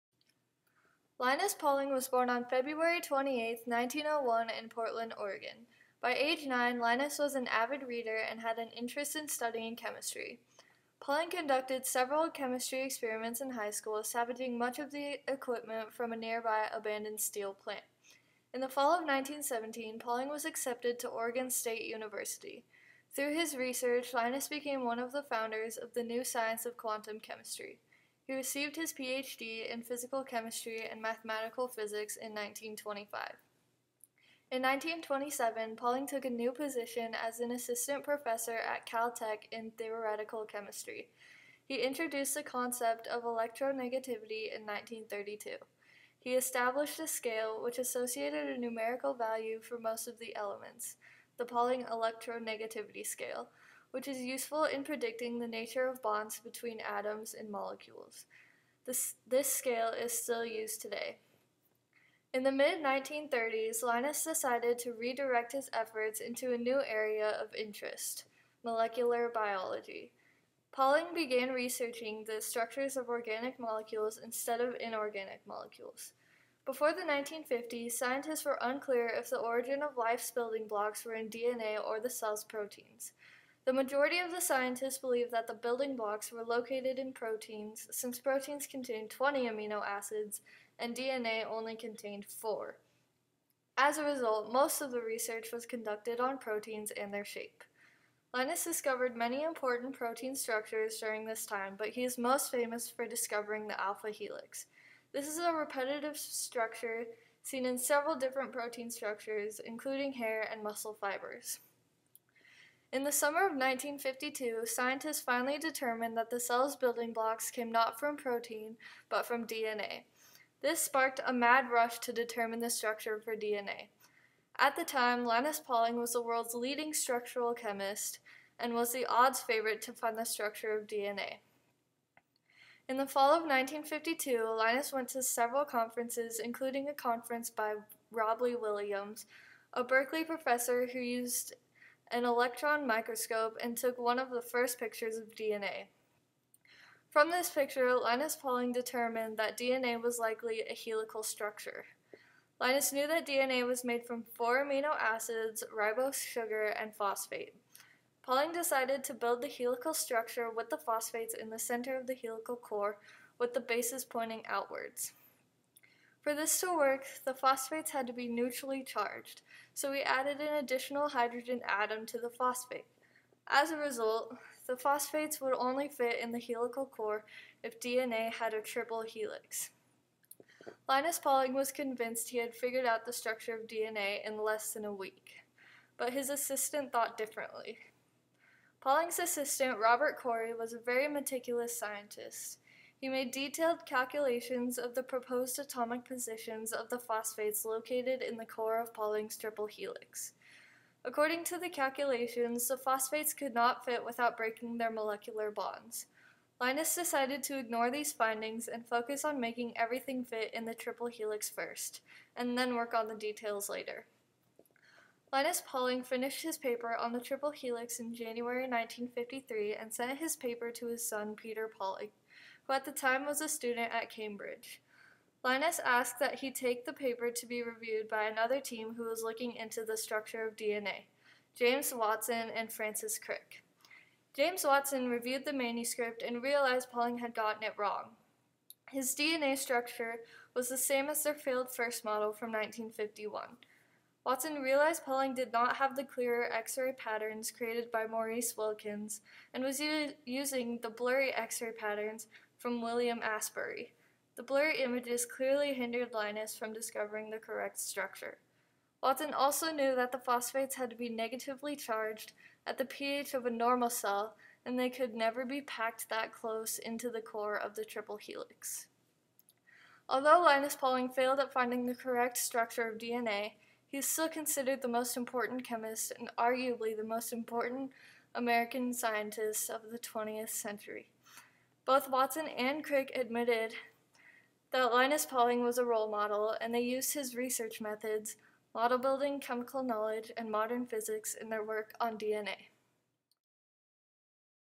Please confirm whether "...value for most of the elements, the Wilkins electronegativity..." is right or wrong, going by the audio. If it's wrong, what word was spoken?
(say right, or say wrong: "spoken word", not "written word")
wrong: "Pauling", not "Wilkins".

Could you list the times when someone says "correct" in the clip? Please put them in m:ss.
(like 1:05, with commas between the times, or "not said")
4:17, 4:31.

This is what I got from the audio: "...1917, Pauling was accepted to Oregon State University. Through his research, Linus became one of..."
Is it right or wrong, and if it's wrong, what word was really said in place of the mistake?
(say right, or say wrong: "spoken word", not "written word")
right.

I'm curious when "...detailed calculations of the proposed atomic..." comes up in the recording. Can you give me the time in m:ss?
3:13.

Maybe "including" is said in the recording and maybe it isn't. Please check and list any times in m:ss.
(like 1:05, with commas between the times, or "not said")
1:49, 2:16.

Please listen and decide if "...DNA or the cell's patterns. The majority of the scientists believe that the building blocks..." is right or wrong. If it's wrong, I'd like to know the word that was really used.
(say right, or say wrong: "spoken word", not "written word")
wrong: "proteins", not "patterns".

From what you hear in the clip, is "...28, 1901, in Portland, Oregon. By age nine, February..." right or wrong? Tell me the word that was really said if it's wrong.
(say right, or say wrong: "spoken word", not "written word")
wrong: "Linus", not "February".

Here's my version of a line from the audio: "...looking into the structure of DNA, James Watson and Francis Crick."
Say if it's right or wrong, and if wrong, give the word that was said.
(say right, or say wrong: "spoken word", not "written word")
right.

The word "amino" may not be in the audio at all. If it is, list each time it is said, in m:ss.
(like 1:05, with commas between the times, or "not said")
1:29, 2:34.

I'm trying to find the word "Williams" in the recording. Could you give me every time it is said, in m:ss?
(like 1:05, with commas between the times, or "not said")
2:18, 4:12.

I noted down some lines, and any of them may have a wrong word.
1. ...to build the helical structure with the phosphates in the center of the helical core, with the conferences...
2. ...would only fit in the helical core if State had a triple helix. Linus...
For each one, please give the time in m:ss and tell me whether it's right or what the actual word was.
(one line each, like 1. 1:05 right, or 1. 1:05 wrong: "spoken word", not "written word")
1. 2:39 wrong: "bases", not "conferences"
2. 2:55 wrong: "DNA", not "State".